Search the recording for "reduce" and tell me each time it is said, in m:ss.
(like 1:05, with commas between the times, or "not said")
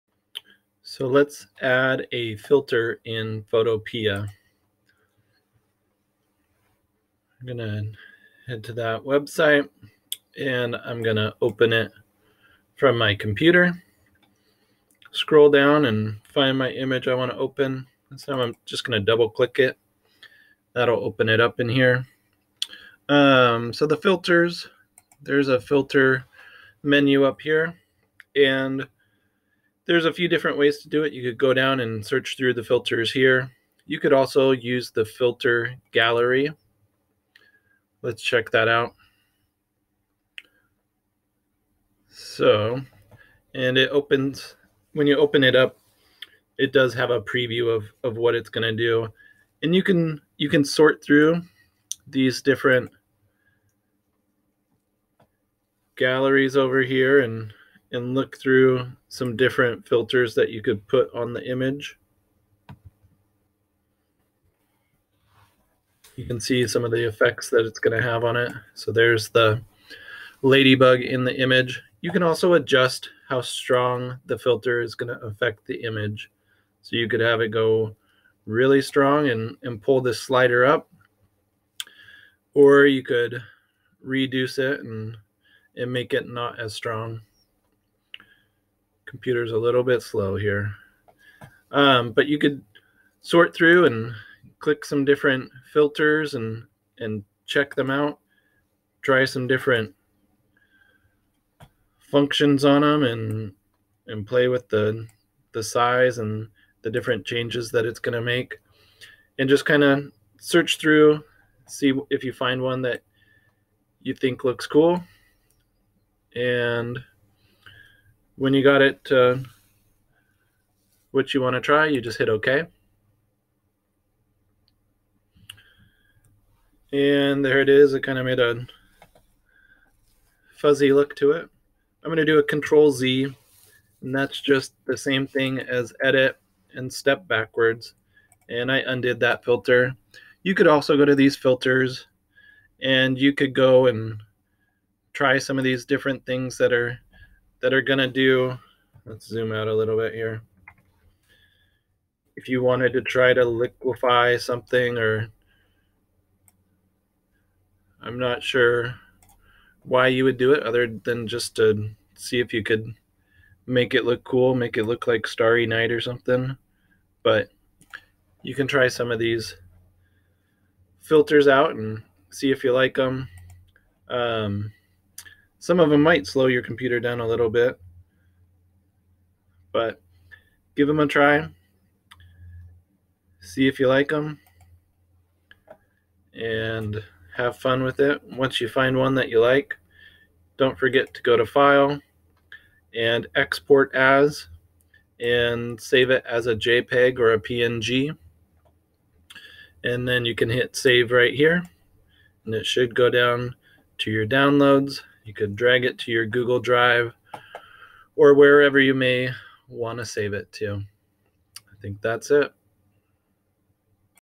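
1:24.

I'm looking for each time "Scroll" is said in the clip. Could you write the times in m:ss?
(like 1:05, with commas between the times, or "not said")
0:15.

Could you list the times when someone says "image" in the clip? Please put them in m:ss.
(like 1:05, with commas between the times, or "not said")
0:16, 1:01, 1:11, 1:15.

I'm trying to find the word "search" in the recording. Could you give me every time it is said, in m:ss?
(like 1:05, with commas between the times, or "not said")
0:32, 1:50.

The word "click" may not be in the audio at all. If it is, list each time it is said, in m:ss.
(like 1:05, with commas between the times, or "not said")
0:19, 1:34.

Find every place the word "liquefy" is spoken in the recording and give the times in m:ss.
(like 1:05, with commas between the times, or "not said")
2:33.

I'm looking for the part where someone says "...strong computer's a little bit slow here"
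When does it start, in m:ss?
1:26.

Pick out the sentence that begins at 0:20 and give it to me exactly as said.
That'll open it up in here.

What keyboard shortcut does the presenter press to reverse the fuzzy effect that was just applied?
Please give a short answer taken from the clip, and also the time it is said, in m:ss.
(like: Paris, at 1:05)
Control Z, at 2:12.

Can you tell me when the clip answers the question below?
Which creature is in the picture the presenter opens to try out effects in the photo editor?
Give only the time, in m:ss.
1:10.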